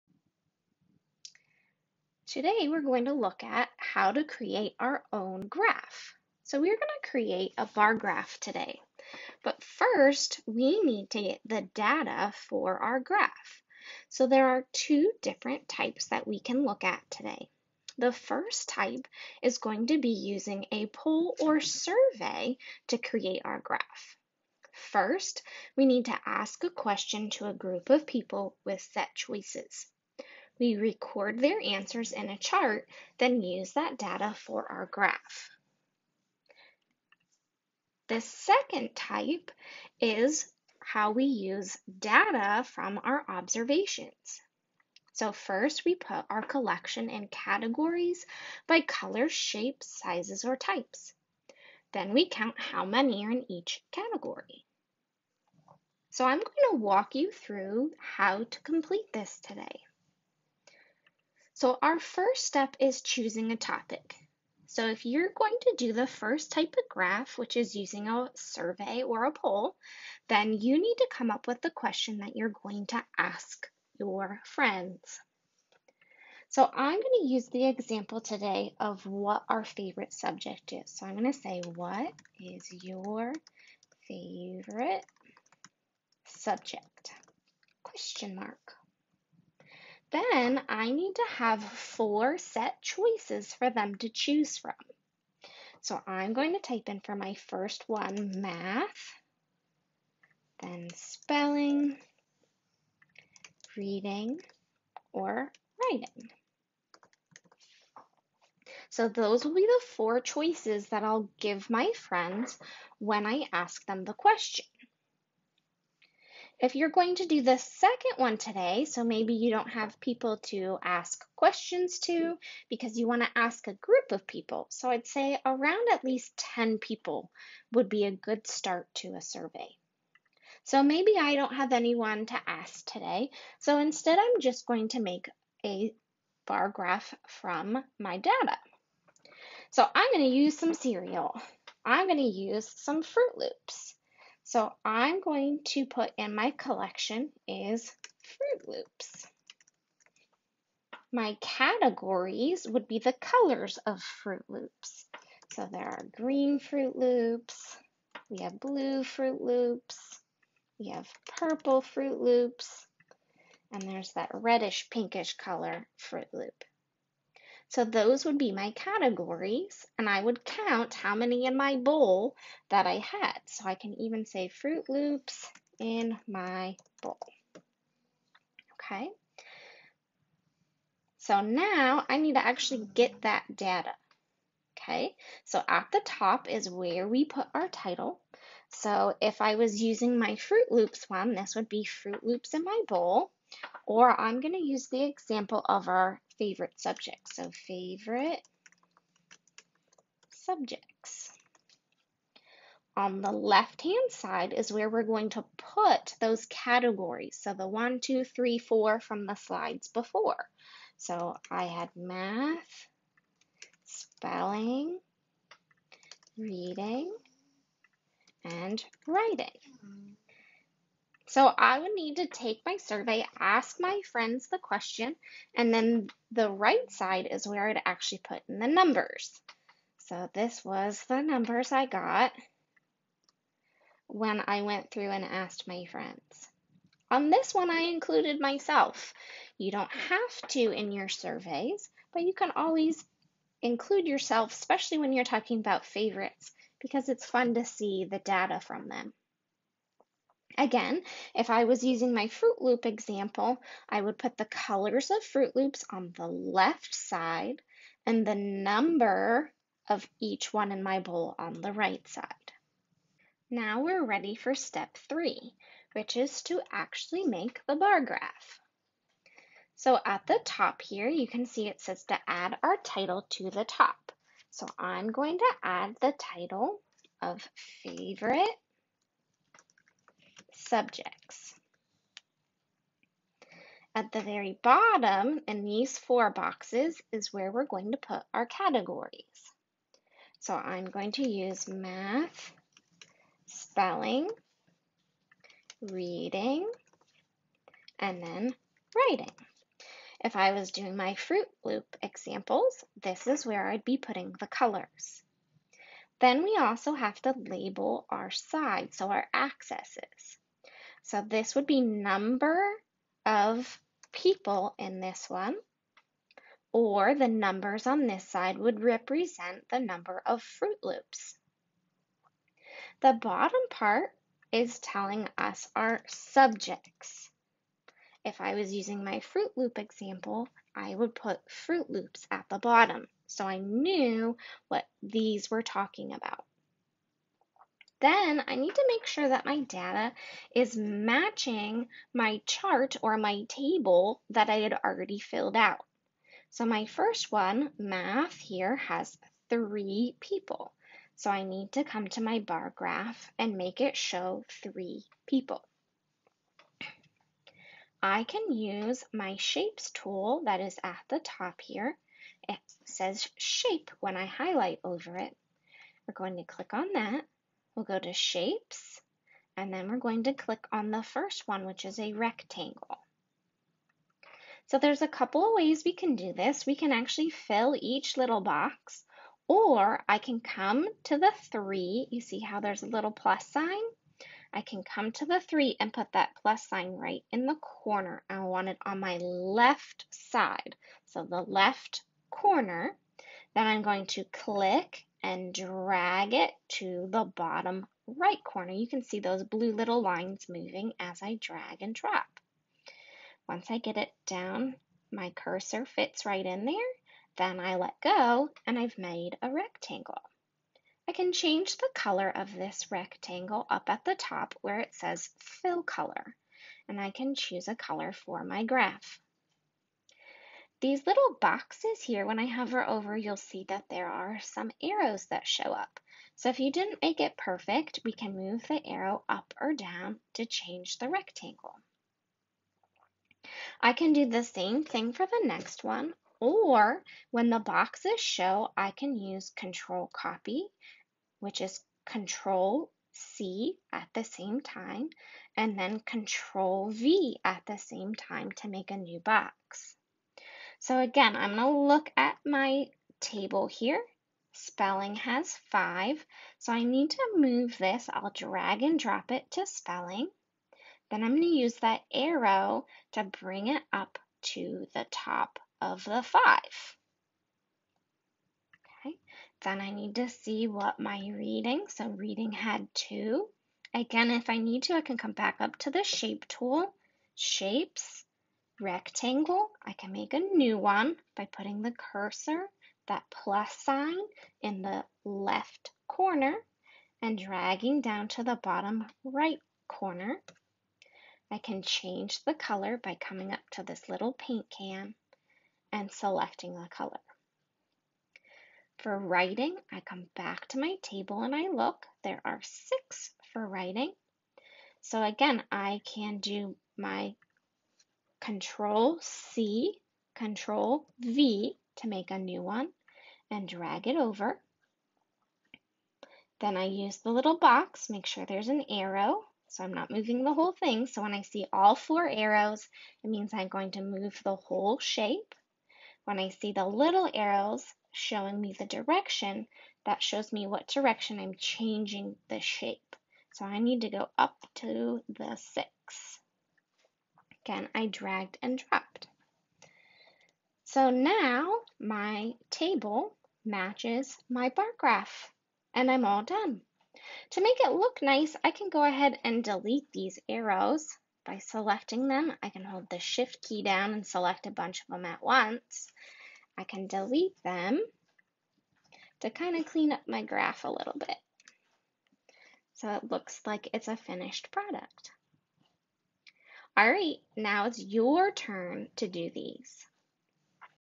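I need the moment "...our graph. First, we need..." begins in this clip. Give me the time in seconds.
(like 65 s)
23 s.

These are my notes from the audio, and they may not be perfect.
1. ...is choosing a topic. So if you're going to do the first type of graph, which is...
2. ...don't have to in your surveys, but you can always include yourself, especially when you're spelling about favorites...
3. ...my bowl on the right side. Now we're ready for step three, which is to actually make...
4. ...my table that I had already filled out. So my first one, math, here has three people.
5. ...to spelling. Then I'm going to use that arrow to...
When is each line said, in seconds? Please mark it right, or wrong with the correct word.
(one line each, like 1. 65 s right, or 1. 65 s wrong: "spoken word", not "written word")
1. 62 s right
2. 239 s wrong: "talking", not "spelling"
3. 260 s right
4. 343 s right
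5. 459 s right.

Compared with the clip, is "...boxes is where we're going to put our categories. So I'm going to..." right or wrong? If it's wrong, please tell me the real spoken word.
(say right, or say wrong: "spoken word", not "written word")
right.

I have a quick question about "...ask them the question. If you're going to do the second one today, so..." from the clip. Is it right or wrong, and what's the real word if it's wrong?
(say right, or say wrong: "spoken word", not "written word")
right.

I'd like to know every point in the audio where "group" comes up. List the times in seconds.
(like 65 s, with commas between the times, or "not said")
27 s, 123 s.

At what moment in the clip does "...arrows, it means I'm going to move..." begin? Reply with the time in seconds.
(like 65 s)
522 s.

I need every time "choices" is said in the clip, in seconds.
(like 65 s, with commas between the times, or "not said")
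29 s, 92 s, 110 s.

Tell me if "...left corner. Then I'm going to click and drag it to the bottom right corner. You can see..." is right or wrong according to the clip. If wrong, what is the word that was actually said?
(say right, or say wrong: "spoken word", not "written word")
right.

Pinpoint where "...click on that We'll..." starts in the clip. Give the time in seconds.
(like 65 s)
366 s.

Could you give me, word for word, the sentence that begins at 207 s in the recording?
So the one, two, three, four from the slides before.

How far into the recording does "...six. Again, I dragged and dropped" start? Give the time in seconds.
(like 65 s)
535 s.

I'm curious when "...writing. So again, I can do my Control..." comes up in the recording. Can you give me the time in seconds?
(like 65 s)
503 s.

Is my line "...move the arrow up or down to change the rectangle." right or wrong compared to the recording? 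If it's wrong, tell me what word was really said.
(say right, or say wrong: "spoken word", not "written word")
right.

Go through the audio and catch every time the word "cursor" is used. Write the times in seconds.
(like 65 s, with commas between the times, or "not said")
405 s, 481 s.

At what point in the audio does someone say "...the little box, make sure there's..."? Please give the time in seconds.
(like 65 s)
517 s.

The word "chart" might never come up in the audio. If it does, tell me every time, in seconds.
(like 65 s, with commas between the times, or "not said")
32 s, 342 s.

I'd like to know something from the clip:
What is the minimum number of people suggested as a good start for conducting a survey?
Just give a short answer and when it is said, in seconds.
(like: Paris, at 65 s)
10, at 125 s.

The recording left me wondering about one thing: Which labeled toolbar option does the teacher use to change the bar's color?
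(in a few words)
fill color.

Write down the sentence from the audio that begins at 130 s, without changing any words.
So maybe I don't have anyone to ask today.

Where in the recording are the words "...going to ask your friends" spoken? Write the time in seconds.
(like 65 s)
72 s.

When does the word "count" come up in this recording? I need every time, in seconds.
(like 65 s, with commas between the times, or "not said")
52 s, 170 s.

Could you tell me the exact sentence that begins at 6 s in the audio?
So we're going to create a bar graph today.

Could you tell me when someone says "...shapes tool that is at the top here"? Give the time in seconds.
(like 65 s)
359 s.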